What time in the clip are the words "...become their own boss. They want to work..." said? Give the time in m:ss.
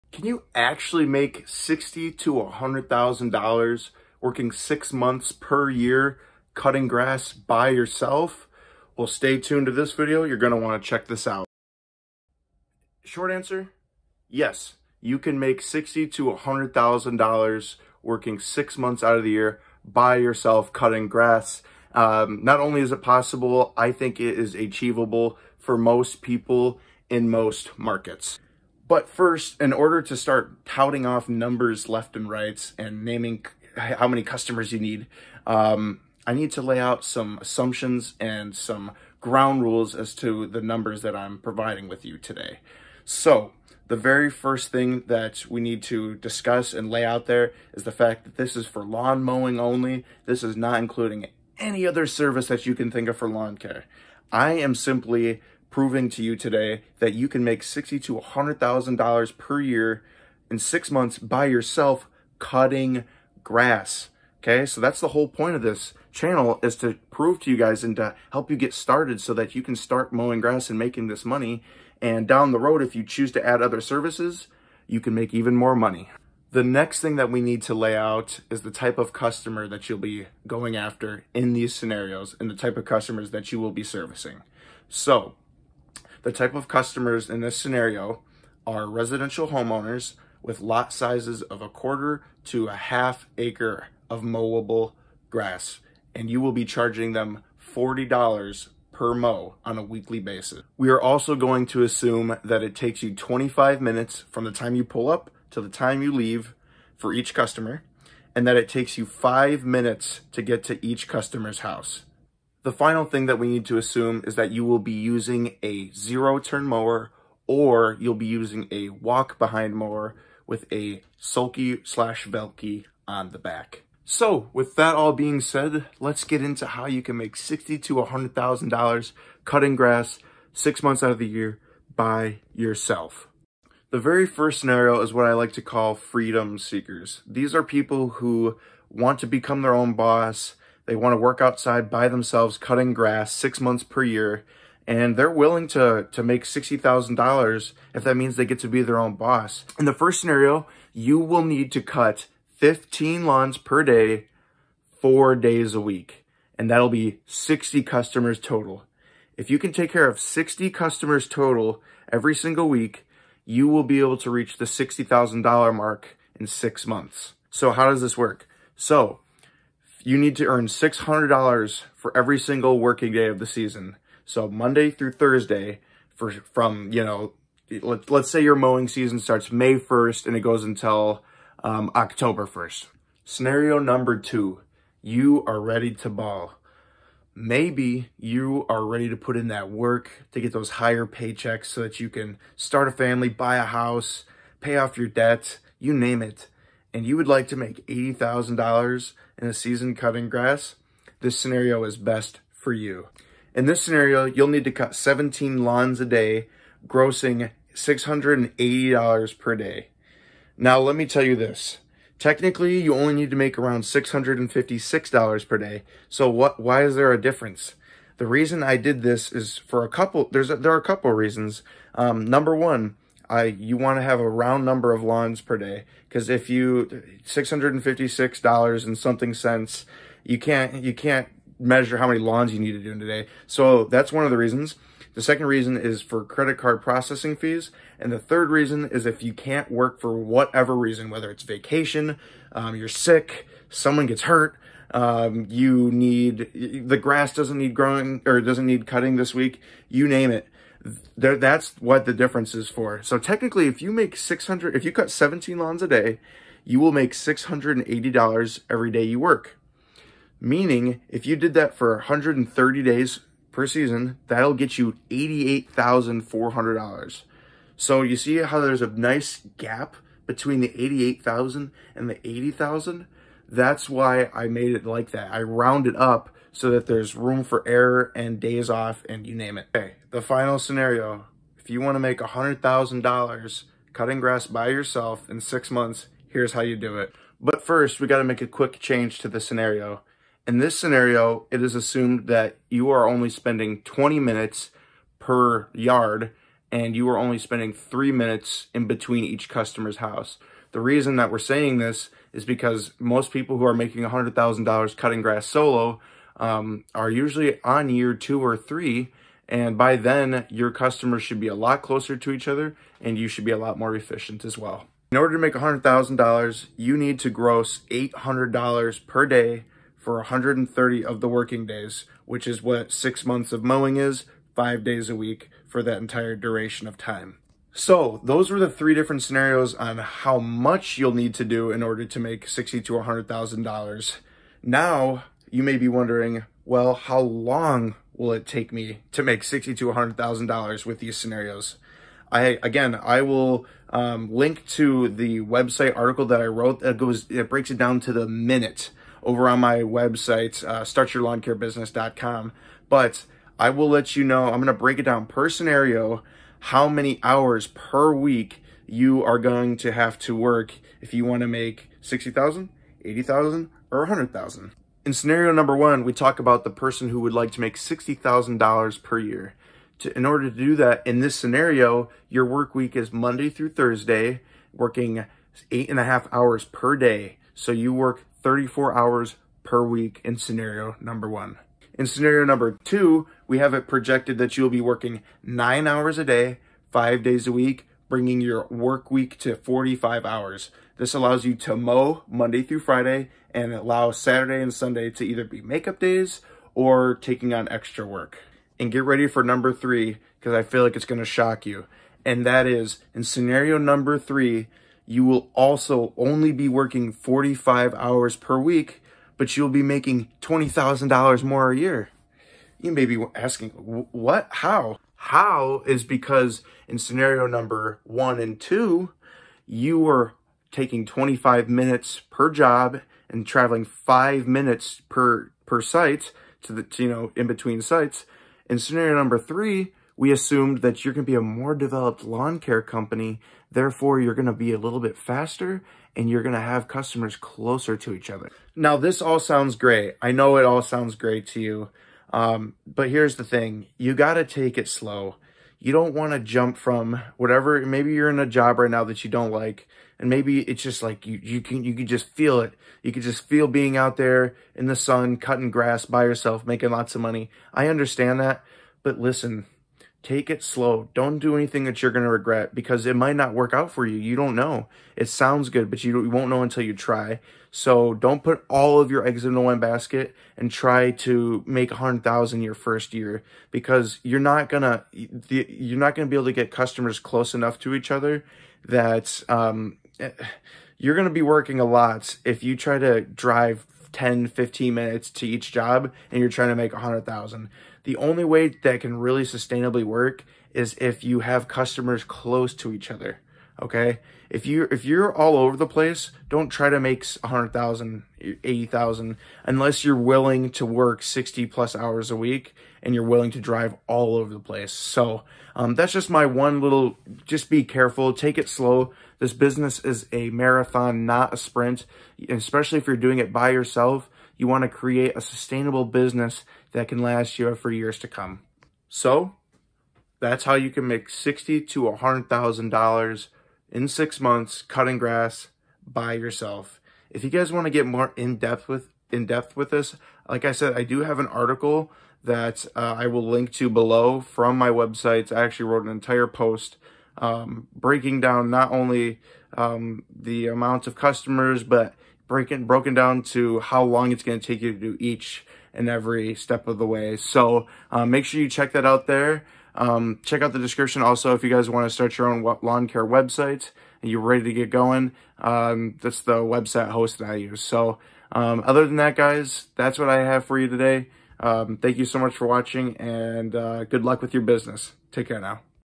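2:19.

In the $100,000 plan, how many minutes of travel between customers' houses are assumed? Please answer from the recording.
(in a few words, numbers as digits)
3 minutes.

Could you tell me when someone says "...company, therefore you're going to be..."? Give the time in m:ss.
7:12.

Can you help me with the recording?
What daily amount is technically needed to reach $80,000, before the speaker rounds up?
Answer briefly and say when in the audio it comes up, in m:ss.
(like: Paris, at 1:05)
$656, at 3:33.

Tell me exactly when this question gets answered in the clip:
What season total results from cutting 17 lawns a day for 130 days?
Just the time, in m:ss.
4:25.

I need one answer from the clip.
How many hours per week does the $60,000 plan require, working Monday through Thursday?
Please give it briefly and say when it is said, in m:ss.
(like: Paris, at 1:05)
34 hours, at 6:18.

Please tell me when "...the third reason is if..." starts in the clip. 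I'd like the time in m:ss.
3:58.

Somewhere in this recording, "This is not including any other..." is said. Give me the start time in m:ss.
0:50.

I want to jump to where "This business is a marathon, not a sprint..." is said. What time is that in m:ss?
8:29.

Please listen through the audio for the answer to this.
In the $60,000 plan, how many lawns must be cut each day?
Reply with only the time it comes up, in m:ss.
2:32.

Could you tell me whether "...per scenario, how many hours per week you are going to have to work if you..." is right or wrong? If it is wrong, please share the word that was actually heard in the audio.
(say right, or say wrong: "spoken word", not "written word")
right.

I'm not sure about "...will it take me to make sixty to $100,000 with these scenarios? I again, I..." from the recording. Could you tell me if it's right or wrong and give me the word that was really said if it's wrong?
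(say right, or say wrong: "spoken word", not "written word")
right.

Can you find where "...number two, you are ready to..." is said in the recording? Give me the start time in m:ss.
3:03.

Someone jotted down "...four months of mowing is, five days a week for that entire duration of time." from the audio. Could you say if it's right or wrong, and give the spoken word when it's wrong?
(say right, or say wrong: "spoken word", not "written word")
wrong: "six", not "four".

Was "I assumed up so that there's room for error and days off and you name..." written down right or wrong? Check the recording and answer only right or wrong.
wrong.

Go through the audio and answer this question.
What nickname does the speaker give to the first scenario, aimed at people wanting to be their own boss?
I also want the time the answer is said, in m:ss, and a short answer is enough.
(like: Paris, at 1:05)
Freedom seekers, at 2:15.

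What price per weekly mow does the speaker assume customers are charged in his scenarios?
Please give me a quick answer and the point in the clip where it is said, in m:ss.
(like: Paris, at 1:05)
$40, at 1:37.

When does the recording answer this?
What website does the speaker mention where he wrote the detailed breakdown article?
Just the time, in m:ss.
5:50.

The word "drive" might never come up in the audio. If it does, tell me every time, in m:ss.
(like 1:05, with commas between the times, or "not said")
8:03, 8:23.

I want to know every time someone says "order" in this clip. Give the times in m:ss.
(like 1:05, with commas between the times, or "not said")
0:29, 5:15, 5:31, 6:10.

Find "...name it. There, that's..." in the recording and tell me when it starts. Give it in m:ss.
4:10.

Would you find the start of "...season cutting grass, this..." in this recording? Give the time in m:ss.
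3:19.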